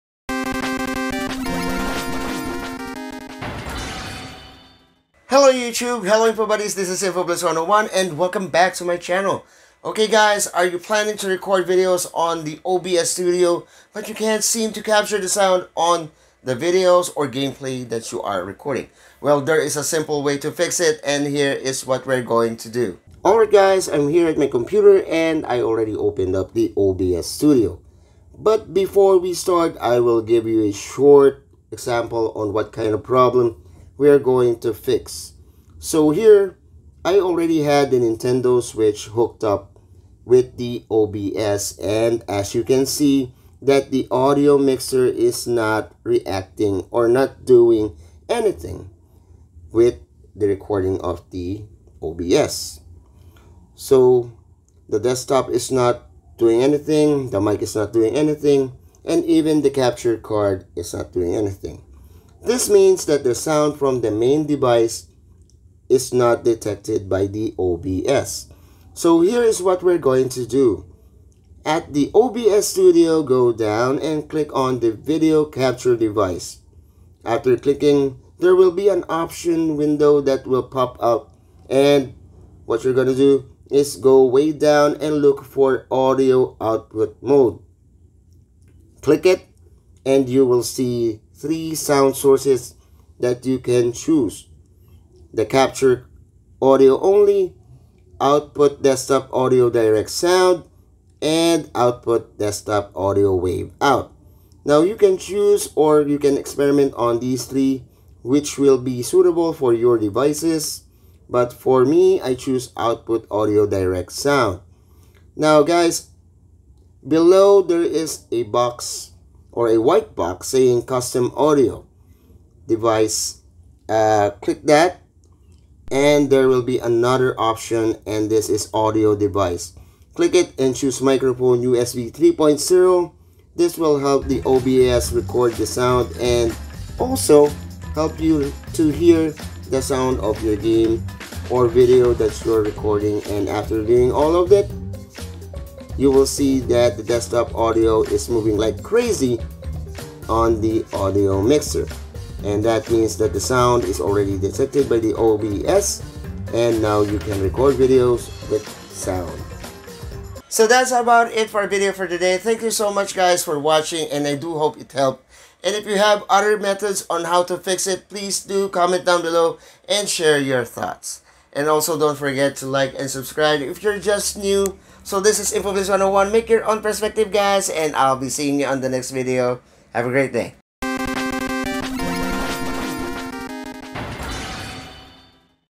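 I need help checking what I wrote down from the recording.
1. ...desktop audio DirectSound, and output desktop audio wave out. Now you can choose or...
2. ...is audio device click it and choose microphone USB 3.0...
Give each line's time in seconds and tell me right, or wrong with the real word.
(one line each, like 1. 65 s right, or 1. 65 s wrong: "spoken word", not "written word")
1. 98 s right
2. 128 s right.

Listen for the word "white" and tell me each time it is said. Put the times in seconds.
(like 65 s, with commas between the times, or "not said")
119 s.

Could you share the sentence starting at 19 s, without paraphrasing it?
Well, there is a simple way to fix it and here is what we're going to do.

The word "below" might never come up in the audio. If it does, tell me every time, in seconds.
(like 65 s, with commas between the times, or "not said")
117 s, 169 s.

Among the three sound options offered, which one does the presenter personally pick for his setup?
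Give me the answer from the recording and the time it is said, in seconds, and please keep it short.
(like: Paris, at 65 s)
output audio DirectSound, at 112 s.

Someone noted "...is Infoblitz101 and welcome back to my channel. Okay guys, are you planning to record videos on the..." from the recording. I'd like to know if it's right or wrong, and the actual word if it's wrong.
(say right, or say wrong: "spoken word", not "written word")
right.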